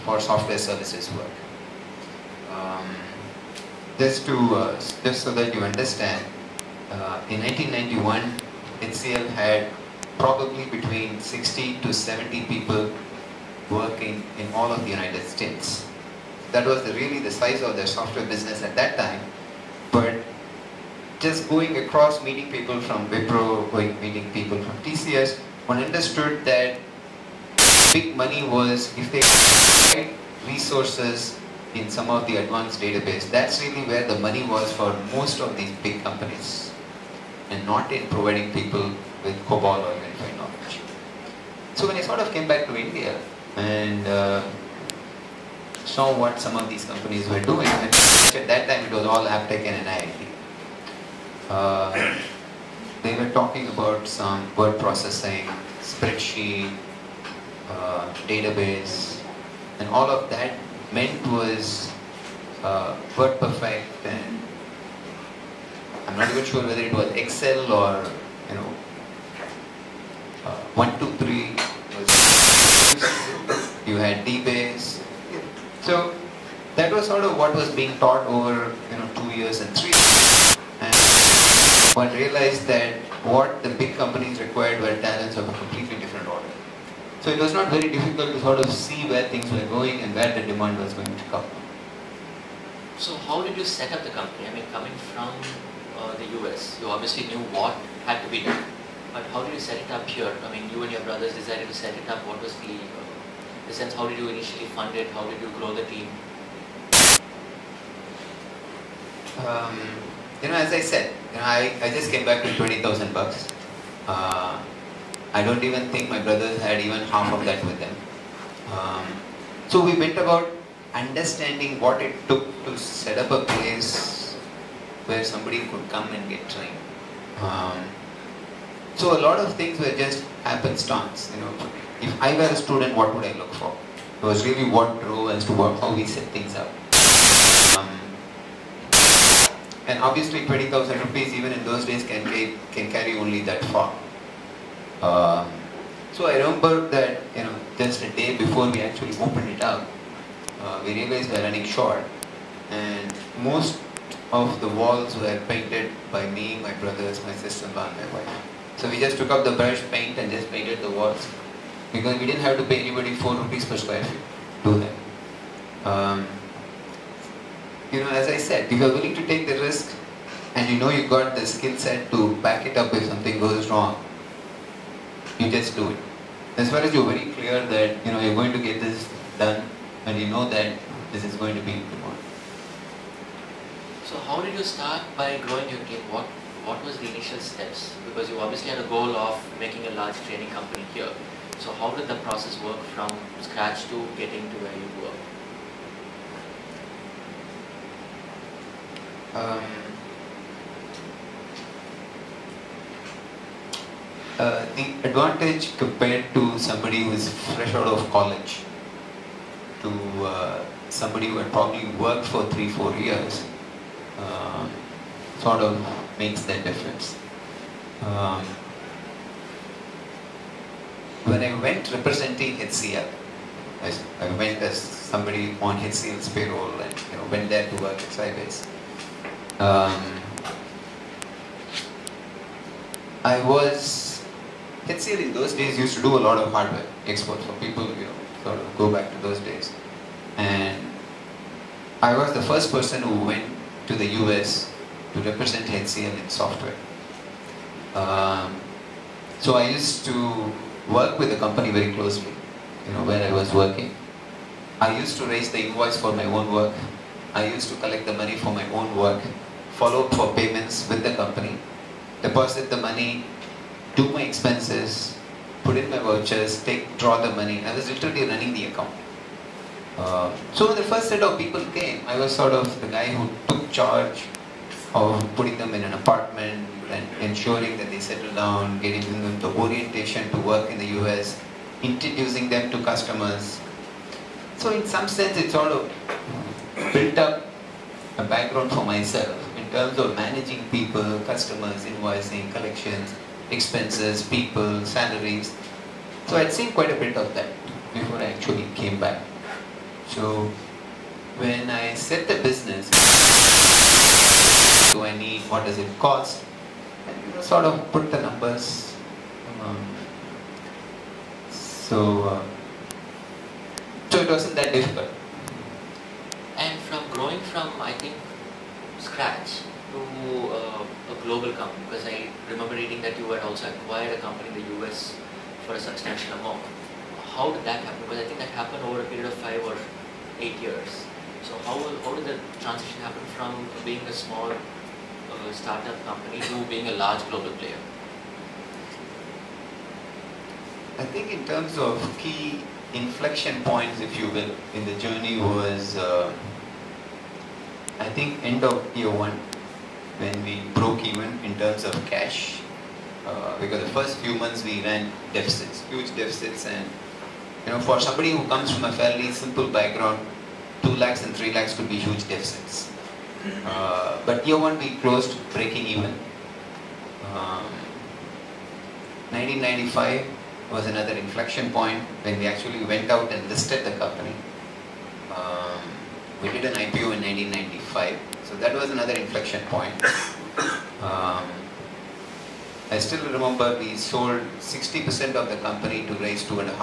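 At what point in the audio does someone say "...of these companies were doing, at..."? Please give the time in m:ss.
0:46.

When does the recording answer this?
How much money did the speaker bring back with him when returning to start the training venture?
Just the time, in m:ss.
1:52.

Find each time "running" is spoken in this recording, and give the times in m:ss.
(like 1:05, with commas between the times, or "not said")
2:31, 4:28.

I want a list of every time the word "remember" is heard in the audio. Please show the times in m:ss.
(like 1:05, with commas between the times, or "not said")
2:26, 5:22, 6:23.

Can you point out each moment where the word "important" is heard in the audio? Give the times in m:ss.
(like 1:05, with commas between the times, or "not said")
3:01.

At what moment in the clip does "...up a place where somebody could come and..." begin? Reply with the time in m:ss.
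2:03.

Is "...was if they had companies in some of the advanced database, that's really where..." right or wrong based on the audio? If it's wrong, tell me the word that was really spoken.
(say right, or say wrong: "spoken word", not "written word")
wrong: "resources", not "companies".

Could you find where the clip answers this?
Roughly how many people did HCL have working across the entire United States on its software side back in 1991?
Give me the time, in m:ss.
0:11.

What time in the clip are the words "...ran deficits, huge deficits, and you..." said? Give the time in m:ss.
5:54.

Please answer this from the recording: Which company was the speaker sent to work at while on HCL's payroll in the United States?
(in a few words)
Sybase.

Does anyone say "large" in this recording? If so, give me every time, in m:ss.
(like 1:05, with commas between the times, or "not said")
3:09, 5:36.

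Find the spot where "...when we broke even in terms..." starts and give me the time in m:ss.
5:50.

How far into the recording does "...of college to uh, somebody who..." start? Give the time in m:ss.
3:27.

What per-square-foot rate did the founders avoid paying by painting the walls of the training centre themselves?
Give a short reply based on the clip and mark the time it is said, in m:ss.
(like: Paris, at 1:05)
4 rupees, at 2:43.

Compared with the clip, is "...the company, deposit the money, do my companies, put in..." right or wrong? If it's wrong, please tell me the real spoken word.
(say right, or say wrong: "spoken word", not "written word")
wrong: "expenses", not "companies".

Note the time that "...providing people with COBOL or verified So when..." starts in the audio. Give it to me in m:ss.
0:38.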